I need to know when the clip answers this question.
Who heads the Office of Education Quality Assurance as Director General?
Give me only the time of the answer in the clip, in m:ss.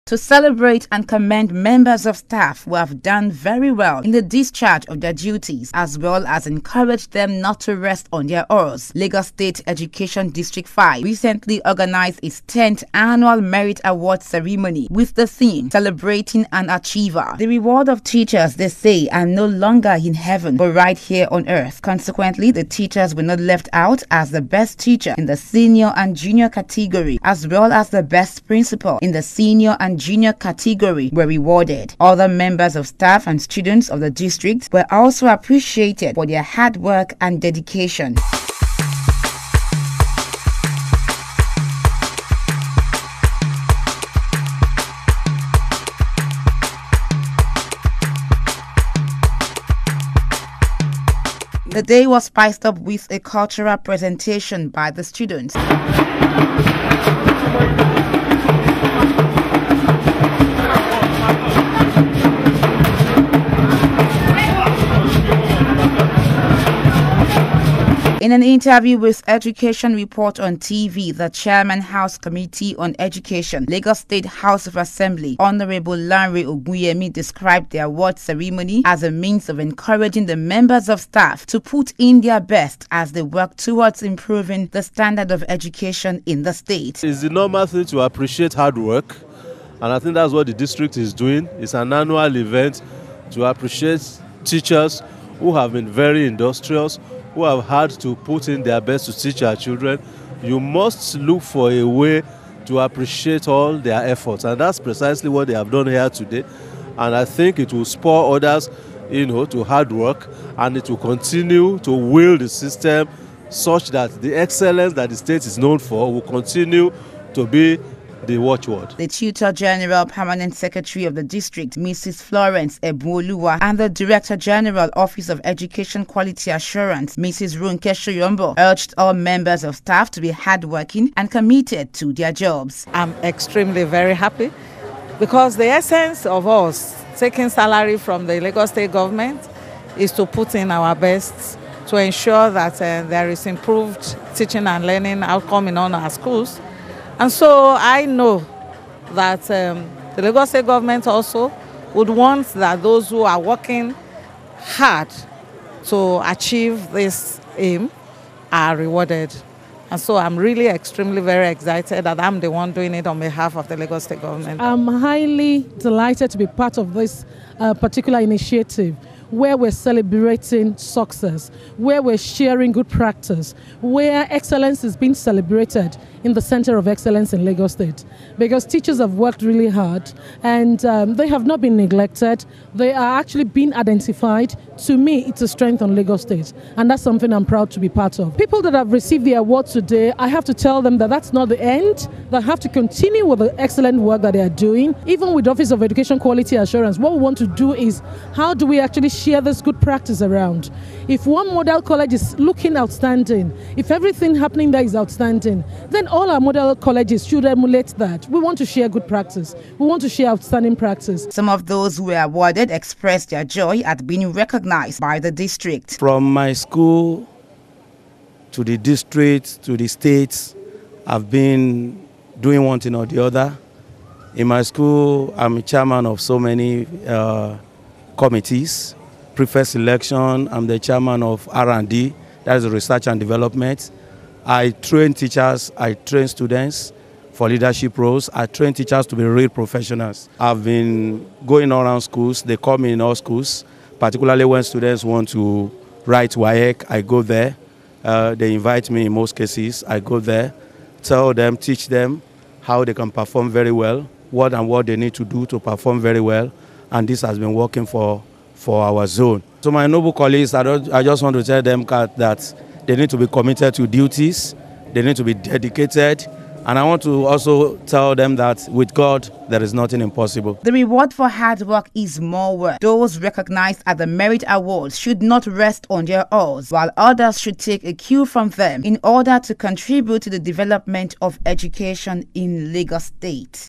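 2:07.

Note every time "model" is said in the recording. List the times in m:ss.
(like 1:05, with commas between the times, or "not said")
3:21, 3:26.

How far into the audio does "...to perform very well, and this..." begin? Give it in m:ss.
4:15.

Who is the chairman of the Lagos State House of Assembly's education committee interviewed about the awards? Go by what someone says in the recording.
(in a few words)
Larry Ogunyemi.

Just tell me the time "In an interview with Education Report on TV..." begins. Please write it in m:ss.
1:08.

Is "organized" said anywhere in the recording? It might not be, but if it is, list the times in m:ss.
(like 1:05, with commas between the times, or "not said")
0:11.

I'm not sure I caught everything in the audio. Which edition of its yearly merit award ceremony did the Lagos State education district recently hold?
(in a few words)
10th.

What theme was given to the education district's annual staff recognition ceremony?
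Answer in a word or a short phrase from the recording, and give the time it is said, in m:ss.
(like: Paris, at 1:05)
Celebrating an Achiever, at 0:15.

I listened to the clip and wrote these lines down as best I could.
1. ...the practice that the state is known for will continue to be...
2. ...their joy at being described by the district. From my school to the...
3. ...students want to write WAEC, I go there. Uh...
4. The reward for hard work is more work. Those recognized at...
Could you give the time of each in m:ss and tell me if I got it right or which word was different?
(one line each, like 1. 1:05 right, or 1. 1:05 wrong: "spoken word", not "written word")
1. 1:54 wrong: "excellence", not "practice"
2. 3:33 wrong: "recognized", not "described"
3. 4:04 right
4. 4:30 right.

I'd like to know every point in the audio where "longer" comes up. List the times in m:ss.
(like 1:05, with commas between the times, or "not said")
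0:19.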